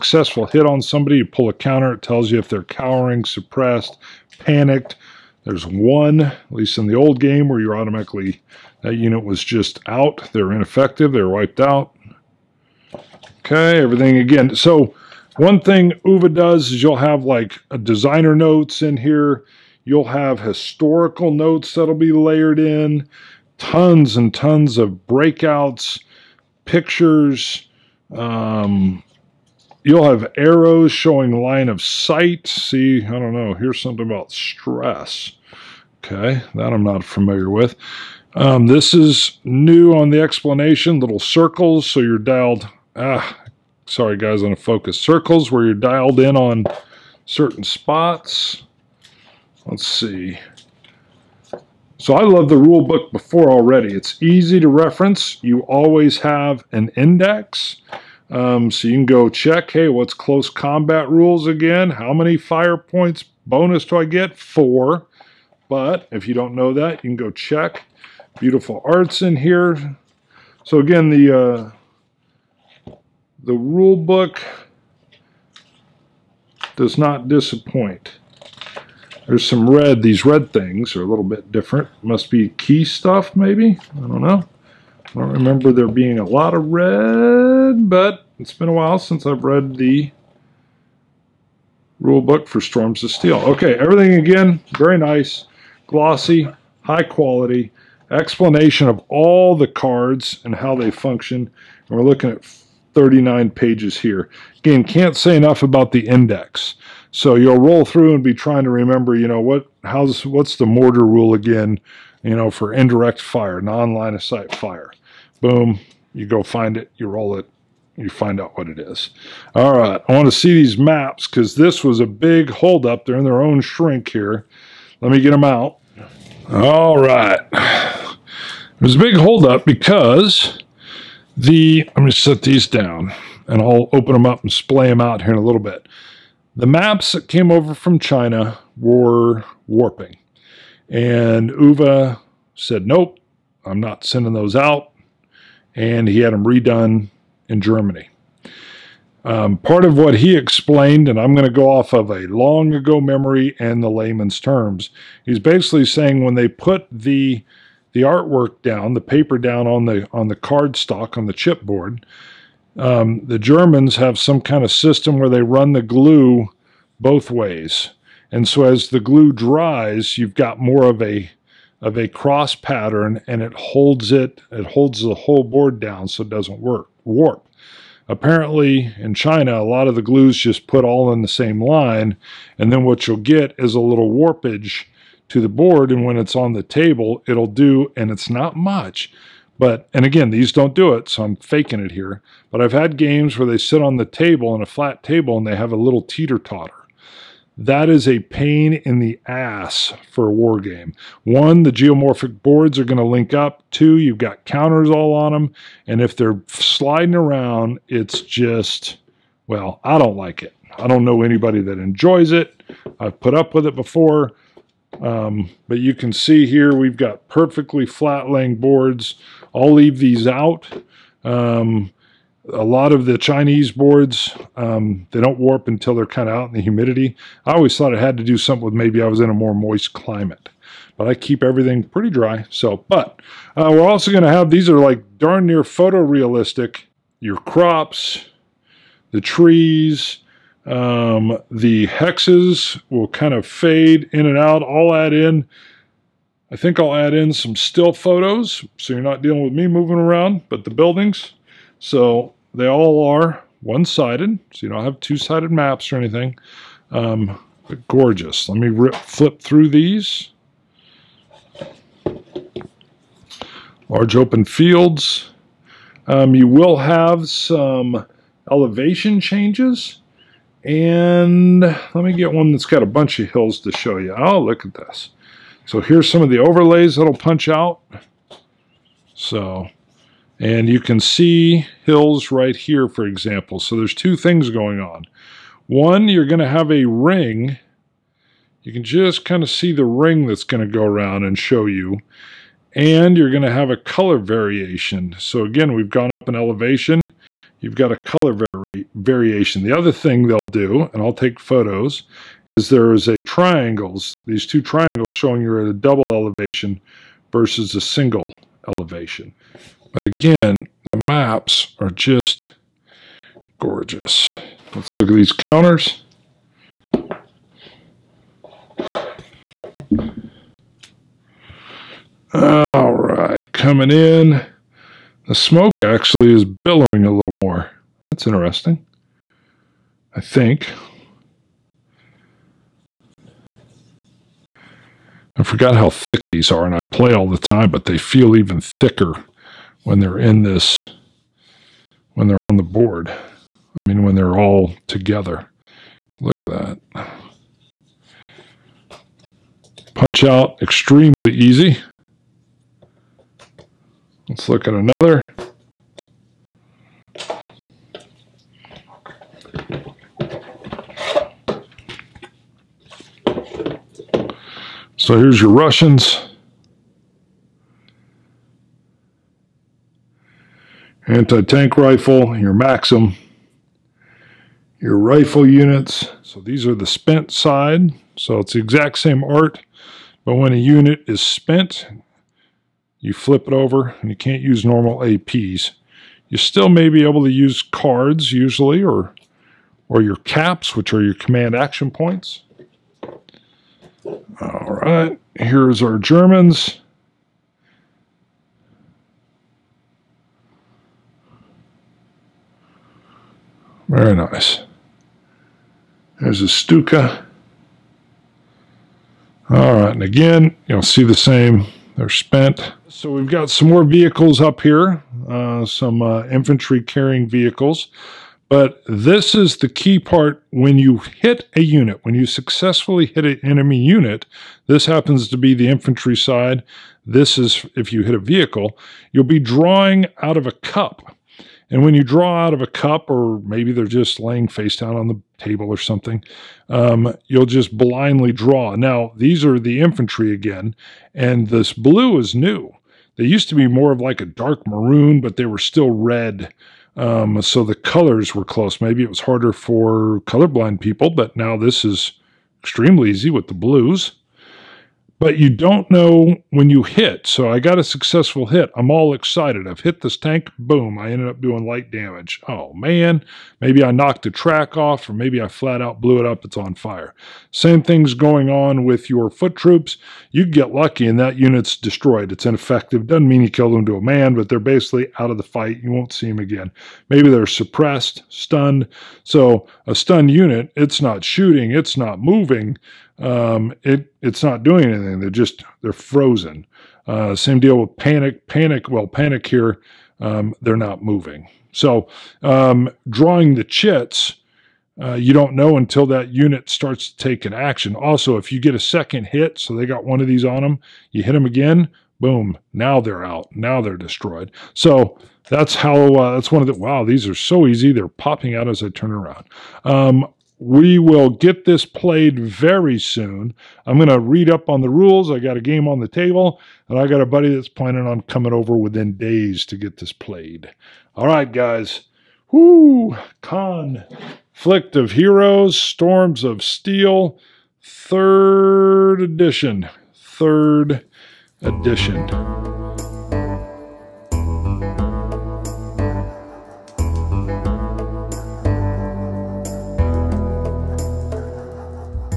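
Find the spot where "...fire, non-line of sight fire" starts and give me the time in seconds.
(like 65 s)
113 s.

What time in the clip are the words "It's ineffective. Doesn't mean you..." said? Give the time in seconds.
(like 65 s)
472 s.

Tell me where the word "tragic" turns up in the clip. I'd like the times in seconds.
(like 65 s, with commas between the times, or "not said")
not said.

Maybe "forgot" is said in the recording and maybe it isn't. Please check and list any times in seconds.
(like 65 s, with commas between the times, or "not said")
335 s.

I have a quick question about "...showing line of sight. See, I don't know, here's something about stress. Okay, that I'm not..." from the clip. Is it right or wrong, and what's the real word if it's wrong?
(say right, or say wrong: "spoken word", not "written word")
right.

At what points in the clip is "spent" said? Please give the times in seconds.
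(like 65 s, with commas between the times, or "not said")
376 s, 381 s, 412 s.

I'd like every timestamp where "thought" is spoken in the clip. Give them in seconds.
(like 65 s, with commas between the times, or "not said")
227 s.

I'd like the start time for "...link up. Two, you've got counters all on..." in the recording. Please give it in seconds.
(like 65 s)
203 s.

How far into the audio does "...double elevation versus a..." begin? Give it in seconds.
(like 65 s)
305 s.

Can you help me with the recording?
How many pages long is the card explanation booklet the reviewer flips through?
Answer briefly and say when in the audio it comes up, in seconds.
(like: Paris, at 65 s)
39, at 102 s.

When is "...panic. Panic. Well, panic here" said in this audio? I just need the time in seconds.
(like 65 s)
487 s.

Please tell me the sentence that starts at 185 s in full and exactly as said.
And when it's on the table, it'll do, and it's not much.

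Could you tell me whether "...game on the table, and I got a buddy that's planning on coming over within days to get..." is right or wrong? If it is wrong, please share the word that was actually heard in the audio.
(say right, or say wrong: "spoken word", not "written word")
right.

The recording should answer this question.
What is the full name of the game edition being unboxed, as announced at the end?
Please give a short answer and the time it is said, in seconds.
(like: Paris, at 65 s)
Storms of Steel third edition, at 525 s.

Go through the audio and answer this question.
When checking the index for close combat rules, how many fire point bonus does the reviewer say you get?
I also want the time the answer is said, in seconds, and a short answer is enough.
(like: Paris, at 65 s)
4, at 64 s.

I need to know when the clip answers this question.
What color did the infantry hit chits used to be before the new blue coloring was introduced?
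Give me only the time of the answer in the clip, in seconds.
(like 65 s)
444 s.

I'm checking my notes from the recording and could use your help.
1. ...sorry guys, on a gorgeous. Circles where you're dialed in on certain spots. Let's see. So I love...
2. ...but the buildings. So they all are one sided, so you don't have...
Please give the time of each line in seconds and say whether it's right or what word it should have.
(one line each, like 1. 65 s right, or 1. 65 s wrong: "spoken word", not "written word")
1. 43 s wrong: "focus", not "gorgeous"
2. 250 s right.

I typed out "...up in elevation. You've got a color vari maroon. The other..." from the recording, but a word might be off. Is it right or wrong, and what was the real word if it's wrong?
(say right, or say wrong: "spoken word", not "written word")
wrong: "variation", not "maroon".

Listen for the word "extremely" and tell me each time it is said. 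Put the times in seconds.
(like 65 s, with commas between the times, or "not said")
350 s, 452 s.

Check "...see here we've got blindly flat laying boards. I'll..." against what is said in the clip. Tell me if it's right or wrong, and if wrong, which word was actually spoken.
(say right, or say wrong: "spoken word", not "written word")
wrong: "perfectly", not "blindly".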